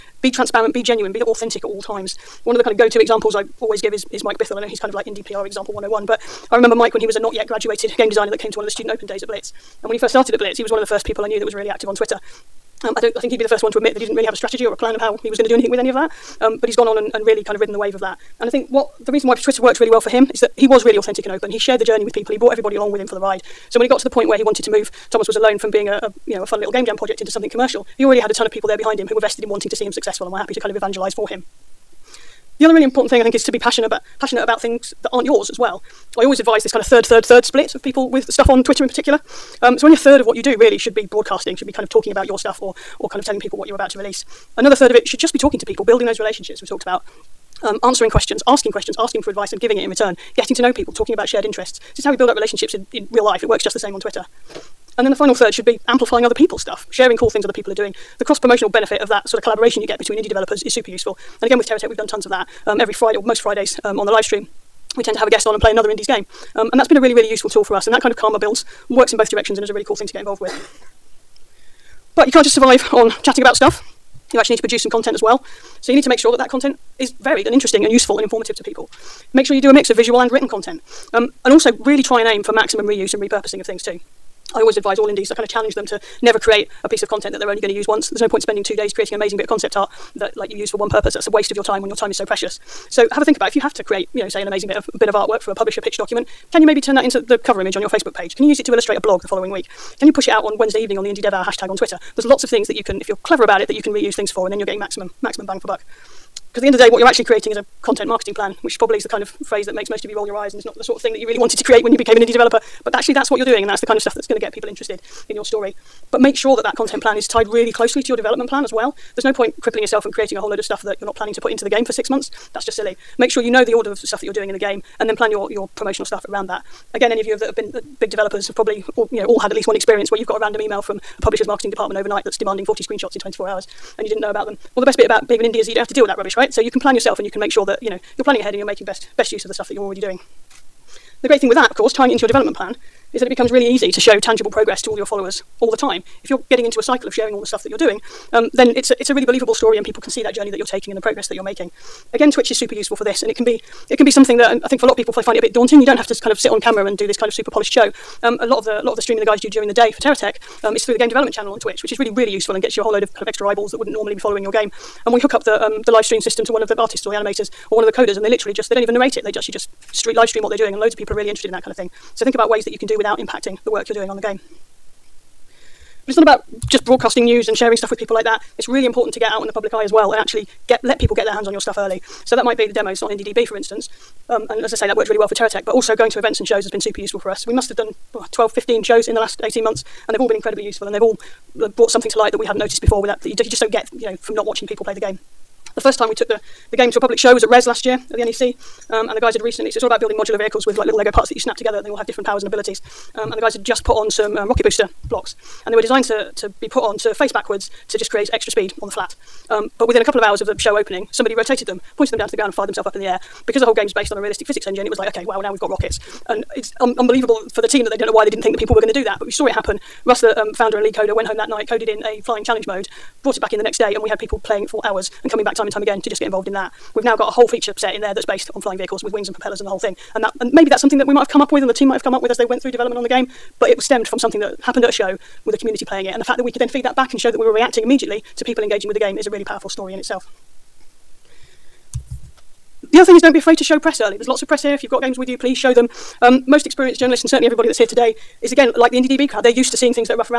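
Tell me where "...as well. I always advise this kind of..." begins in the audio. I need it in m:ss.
0:35.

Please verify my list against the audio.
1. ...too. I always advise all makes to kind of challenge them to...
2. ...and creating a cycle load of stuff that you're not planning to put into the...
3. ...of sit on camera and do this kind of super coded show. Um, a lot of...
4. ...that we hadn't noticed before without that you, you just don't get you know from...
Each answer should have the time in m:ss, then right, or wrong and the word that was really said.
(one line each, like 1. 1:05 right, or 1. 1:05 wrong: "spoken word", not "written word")
1. 1:23 wrong: "indies", not "makes"
2. 2:00 wrong: "whole", not "cycle"
3. 2:36 wrong: "polished", not "coded"
4. 3:12 right.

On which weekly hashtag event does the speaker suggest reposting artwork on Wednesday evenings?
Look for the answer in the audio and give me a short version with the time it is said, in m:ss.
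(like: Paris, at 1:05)
Indie Dev Hour, at 1:41.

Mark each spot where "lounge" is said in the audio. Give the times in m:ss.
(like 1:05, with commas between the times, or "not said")
not said.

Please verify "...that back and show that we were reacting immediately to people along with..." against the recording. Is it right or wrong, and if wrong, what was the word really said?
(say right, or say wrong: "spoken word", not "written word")
wrong: "engaging", not "along".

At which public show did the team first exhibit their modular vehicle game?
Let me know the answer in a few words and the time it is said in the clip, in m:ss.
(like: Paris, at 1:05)
Rezzed, at 3:17.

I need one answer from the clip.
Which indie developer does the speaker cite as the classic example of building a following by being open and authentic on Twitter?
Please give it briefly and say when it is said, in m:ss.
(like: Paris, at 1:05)
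Mike Bithell, at 0:04.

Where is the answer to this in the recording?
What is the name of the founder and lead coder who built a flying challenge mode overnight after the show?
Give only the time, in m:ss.
3:40.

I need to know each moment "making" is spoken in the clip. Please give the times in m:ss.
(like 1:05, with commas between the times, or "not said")
2:18, 2:31.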